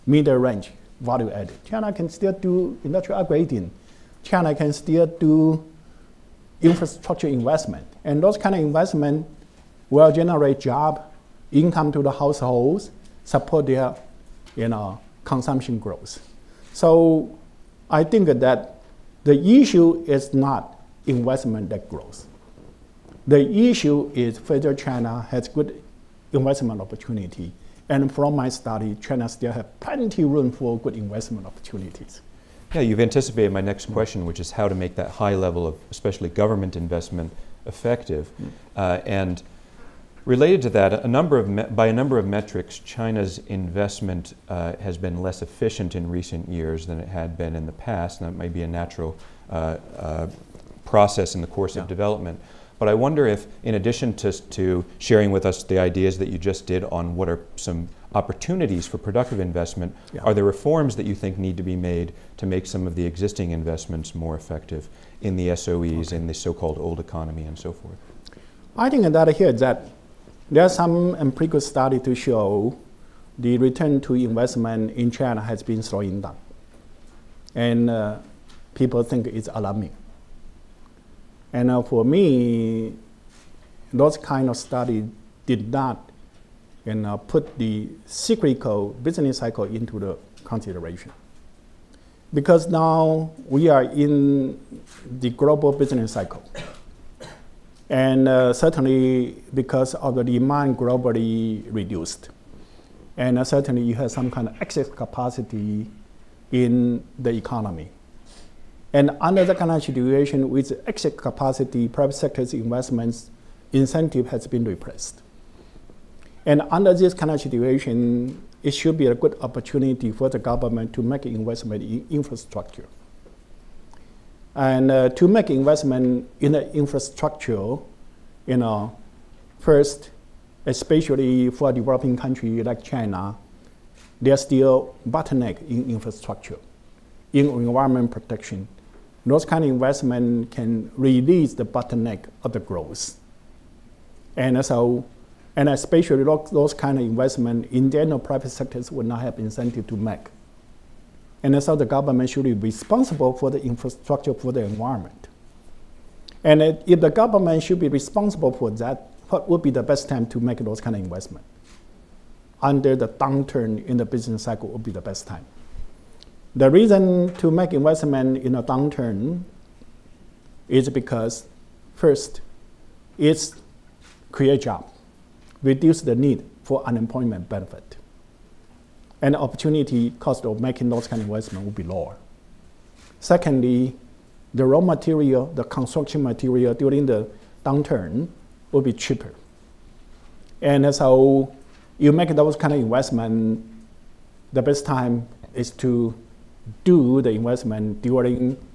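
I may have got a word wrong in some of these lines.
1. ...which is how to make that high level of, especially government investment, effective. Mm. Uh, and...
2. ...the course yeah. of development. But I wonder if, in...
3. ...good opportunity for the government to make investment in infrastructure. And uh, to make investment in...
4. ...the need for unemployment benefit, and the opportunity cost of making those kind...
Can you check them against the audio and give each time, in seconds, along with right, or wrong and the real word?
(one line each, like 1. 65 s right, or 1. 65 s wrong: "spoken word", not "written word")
1. 34 s right
2. 51 s right
3. 119 s right
4. 176 s right.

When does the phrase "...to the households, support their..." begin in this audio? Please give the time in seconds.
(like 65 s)
11 s.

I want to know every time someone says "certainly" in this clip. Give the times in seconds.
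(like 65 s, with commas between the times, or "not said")
98 s, 103 s.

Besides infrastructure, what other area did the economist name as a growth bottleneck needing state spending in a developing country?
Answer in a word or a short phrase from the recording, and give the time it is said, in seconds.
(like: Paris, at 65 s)
environment protection, at 137 s.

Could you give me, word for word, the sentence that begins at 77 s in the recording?
And uh, people think it's alarming.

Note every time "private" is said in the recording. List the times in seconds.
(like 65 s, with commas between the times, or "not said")
111 s, 148 s.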